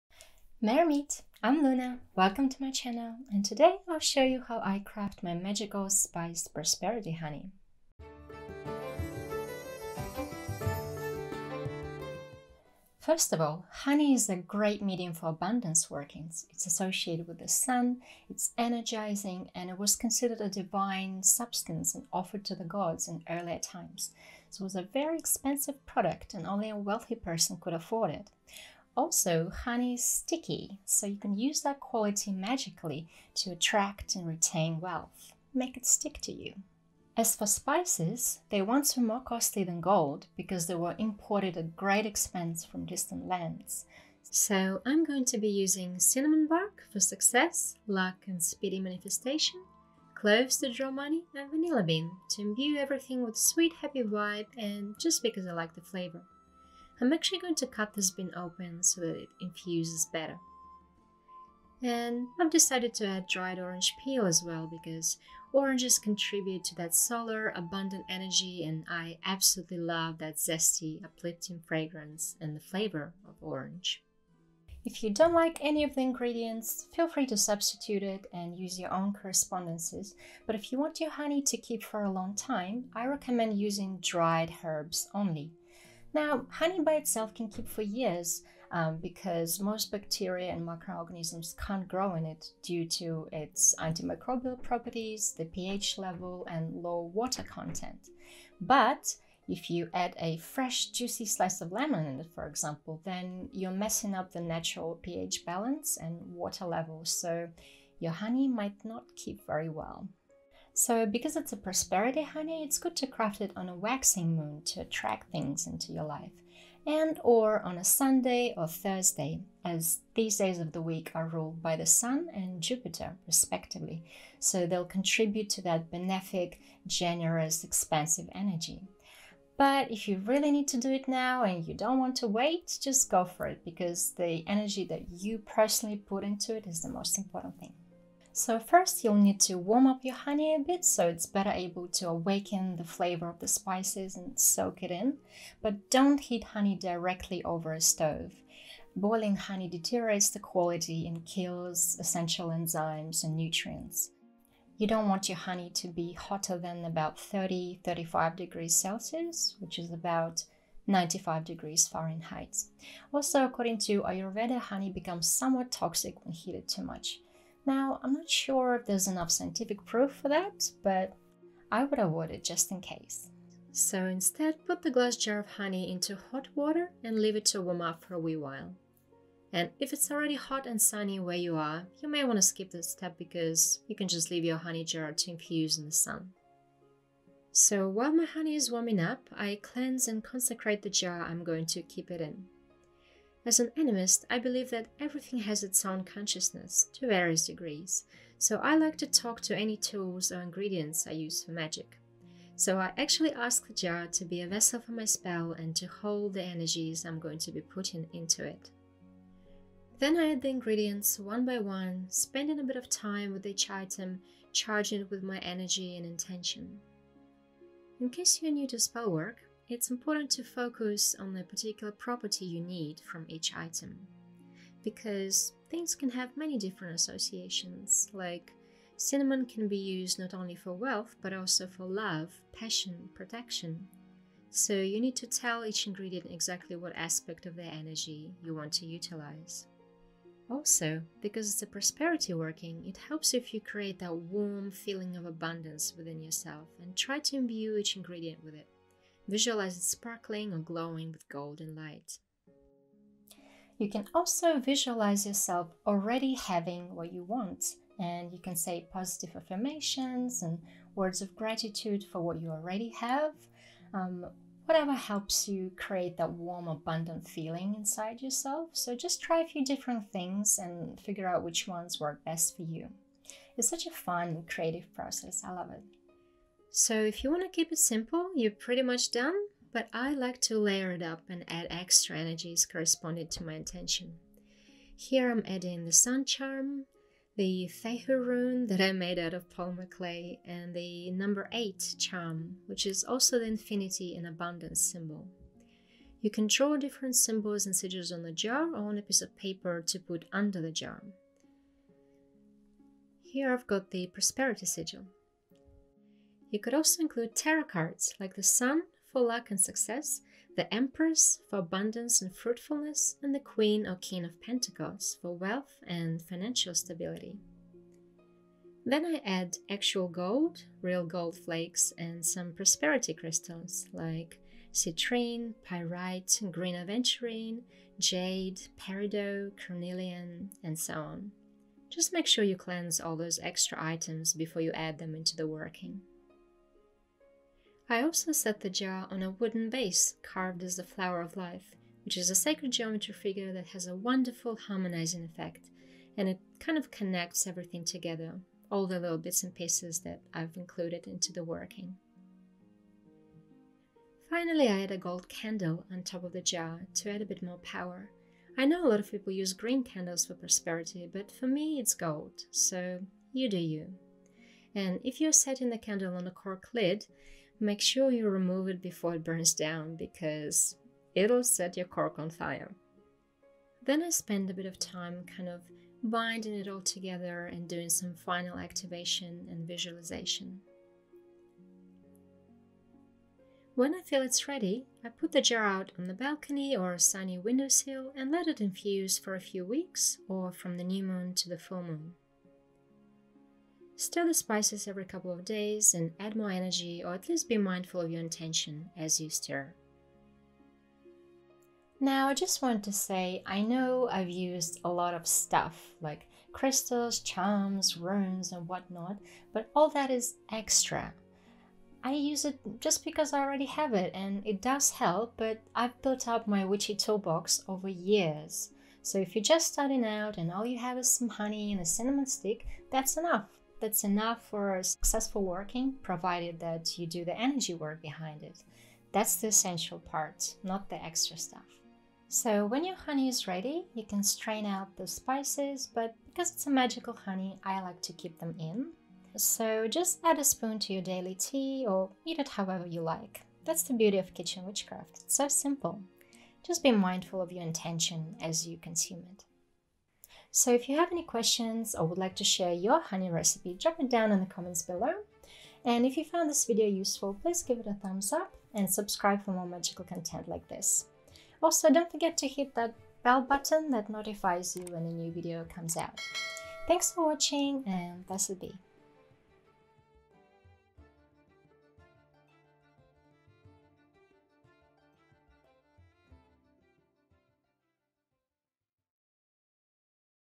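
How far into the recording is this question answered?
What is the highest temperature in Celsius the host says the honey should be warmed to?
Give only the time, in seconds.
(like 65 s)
157 s.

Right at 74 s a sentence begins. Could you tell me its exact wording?
If you don't like any of the ingredients, feel free to substitute it and use your own correspondences.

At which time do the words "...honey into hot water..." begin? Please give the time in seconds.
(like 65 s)
175 s.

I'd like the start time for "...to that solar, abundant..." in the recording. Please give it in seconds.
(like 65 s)
66 s.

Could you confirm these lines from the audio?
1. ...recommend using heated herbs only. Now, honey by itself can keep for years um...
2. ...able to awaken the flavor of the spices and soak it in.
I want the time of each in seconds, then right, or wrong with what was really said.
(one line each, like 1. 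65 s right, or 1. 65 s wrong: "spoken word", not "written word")
1. 83 s wrong: "dried", not "heated"
2. 141 s right.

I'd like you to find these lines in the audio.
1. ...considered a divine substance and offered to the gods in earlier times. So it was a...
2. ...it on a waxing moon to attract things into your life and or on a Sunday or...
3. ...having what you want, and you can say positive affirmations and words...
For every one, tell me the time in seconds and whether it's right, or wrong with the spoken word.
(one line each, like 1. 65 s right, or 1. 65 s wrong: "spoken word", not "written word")
1. 19 s right
2. 113 s right
3. 256 s right.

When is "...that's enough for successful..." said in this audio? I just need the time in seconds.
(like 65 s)
423 s.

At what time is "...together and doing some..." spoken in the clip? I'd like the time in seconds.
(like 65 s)
376 s.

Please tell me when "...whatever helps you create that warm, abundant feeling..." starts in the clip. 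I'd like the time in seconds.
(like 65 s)
264 s.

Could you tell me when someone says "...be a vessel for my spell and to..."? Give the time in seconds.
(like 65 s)
204 s.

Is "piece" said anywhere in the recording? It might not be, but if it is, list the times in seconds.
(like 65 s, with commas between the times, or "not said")
299 s, 349 s.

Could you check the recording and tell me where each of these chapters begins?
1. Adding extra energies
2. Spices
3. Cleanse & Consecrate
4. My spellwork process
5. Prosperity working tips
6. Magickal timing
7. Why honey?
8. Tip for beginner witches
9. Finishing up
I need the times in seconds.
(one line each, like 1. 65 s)
1. 276 s
2. 37 s
3. 189 s
4. 209 s
5. 240 s
6. 110 s
7. 13 s
8. 219 s
9. 373 s.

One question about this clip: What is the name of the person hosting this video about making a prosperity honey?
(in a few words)
Luna.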